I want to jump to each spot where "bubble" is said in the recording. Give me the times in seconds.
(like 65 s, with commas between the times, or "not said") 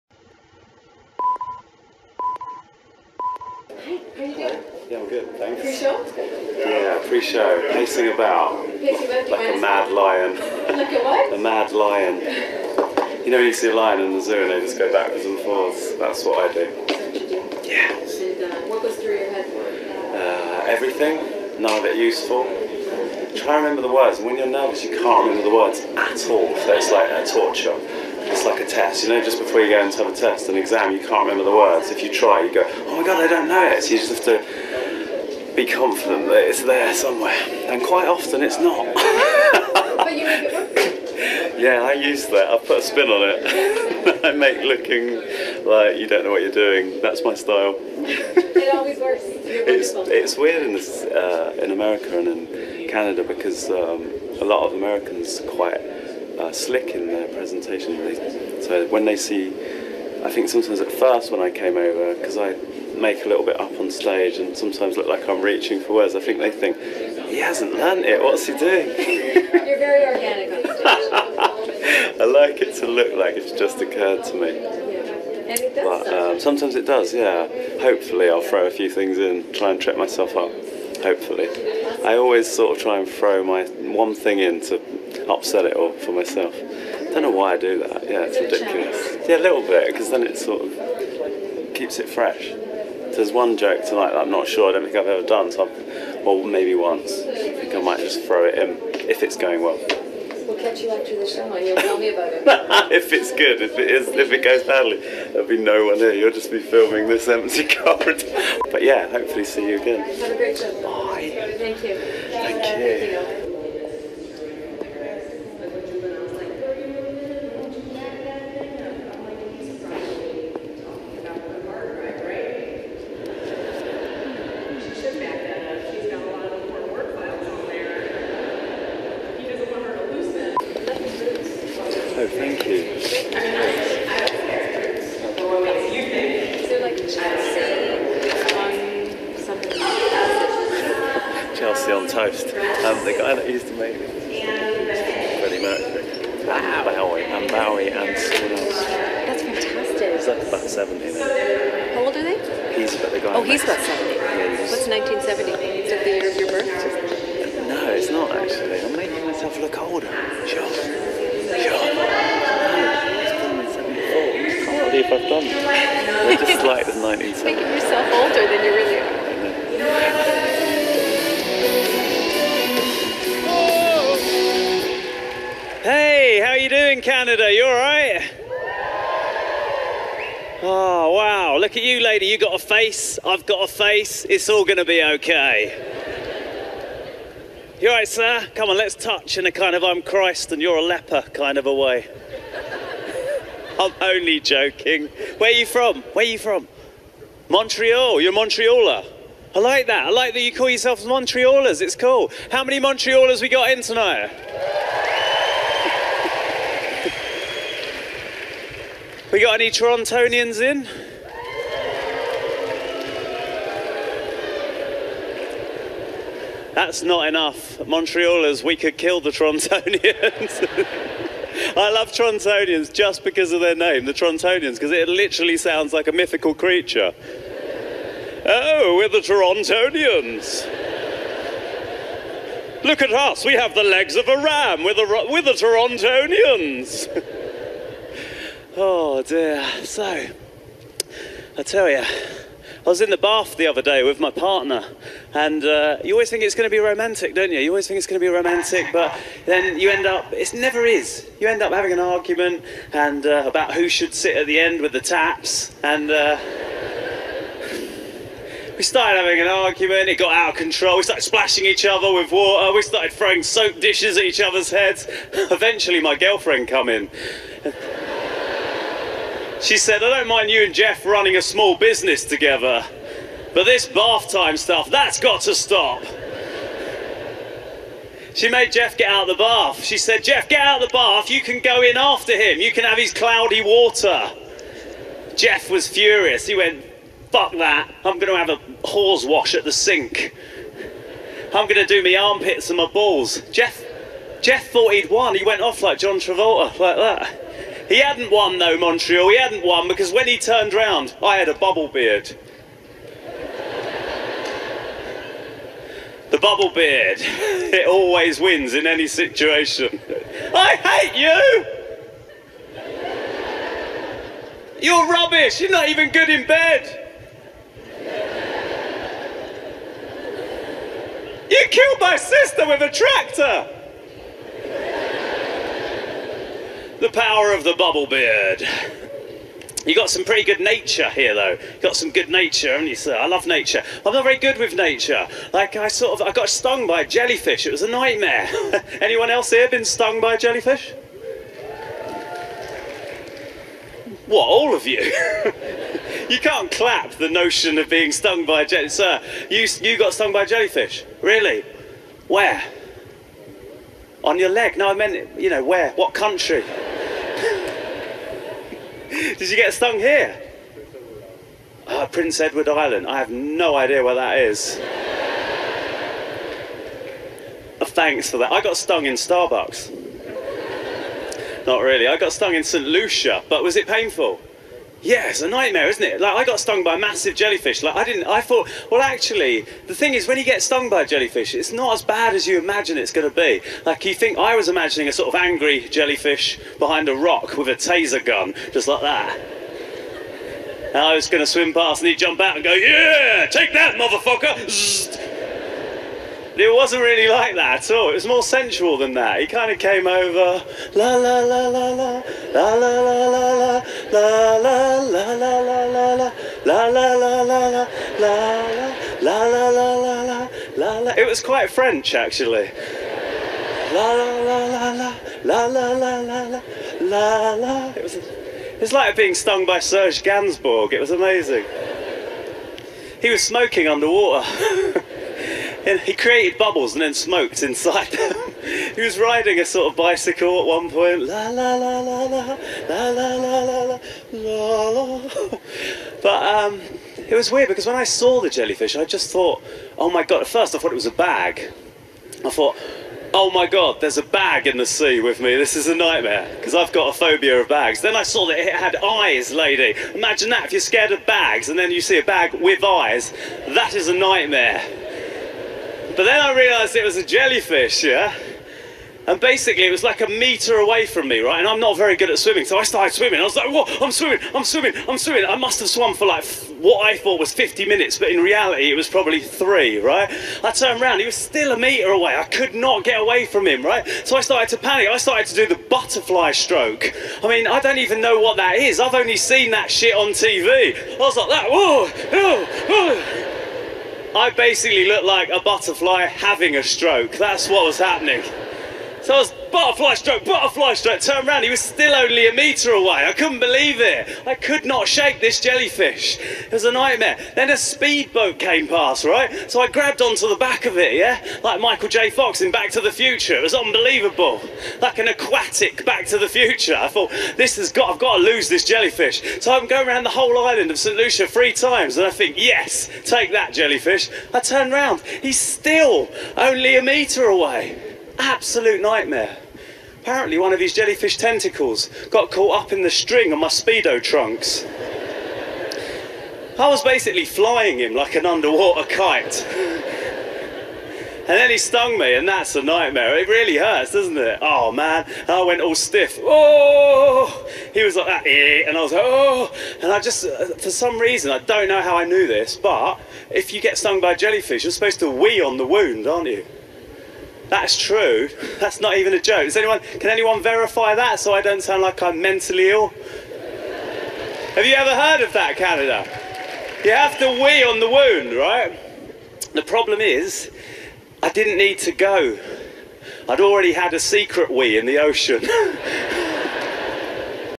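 301 s, 306 s, 327 s, 426 s.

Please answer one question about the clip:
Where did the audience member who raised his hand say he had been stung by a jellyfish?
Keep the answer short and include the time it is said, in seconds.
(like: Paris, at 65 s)
Prince Edward Island, at 362 s.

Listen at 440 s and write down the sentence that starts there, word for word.
At first, I thought it was a bag.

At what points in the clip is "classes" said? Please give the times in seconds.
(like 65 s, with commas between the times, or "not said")
not said.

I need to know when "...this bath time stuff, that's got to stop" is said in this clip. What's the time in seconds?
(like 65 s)
273 s.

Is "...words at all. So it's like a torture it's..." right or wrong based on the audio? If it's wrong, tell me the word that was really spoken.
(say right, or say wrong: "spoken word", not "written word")
right.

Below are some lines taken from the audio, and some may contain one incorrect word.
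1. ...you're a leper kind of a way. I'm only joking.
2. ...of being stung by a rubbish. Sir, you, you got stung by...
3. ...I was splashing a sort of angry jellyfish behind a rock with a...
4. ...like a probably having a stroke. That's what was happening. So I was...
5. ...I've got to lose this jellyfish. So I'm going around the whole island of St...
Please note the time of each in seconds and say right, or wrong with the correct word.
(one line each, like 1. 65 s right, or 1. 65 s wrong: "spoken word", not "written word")
1. 190 s right
2. 347 s wrong: "jellyfish", not "rubbish"
3. 384 s wrong: "imagining", not "splashing"
4. 485 s wrong: "butterfly", not "probably"
5. 508 s right.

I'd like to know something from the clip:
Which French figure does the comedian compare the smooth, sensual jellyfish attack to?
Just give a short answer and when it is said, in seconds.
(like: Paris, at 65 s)
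Serge Gainsbourg, at 419 s.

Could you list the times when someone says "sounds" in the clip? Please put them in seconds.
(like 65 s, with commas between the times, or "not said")
225 s, 551 s.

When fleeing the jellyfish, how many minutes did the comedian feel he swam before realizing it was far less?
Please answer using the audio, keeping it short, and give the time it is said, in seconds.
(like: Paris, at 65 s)
50, at 467 s.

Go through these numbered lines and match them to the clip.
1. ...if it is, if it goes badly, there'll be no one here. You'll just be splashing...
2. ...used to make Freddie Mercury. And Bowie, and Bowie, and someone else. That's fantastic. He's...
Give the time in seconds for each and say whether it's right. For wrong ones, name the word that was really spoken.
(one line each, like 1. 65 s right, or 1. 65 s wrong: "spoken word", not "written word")
1. 103 s wrong: "filming", not "splashing"
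2. 143 s right.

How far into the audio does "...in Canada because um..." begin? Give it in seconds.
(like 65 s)
52 s.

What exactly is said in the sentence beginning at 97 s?
I think I might just throw it in if it's going well.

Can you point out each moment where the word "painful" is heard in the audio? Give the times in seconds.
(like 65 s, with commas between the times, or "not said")
373 s.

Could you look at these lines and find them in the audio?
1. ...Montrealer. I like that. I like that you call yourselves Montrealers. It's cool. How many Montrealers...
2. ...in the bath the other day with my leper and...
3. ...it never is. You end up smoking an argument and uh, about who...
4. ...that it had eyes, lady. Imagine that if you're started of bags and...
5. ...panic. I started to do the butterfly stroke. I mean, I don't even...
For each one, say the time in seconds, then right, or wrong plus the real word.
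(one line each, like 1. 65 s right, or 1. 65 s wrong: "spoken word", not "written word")
1. 198 s right
2. 243 s wrong: "partner", not "leper"
3. 250 s wrong: "having", not "smoking"
4. 448 s wrong: "scared", not "started"
5. 474 s right.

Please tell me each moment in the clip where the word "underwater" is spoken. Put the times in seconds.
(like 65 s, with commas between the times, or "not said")
423 s, 528 s.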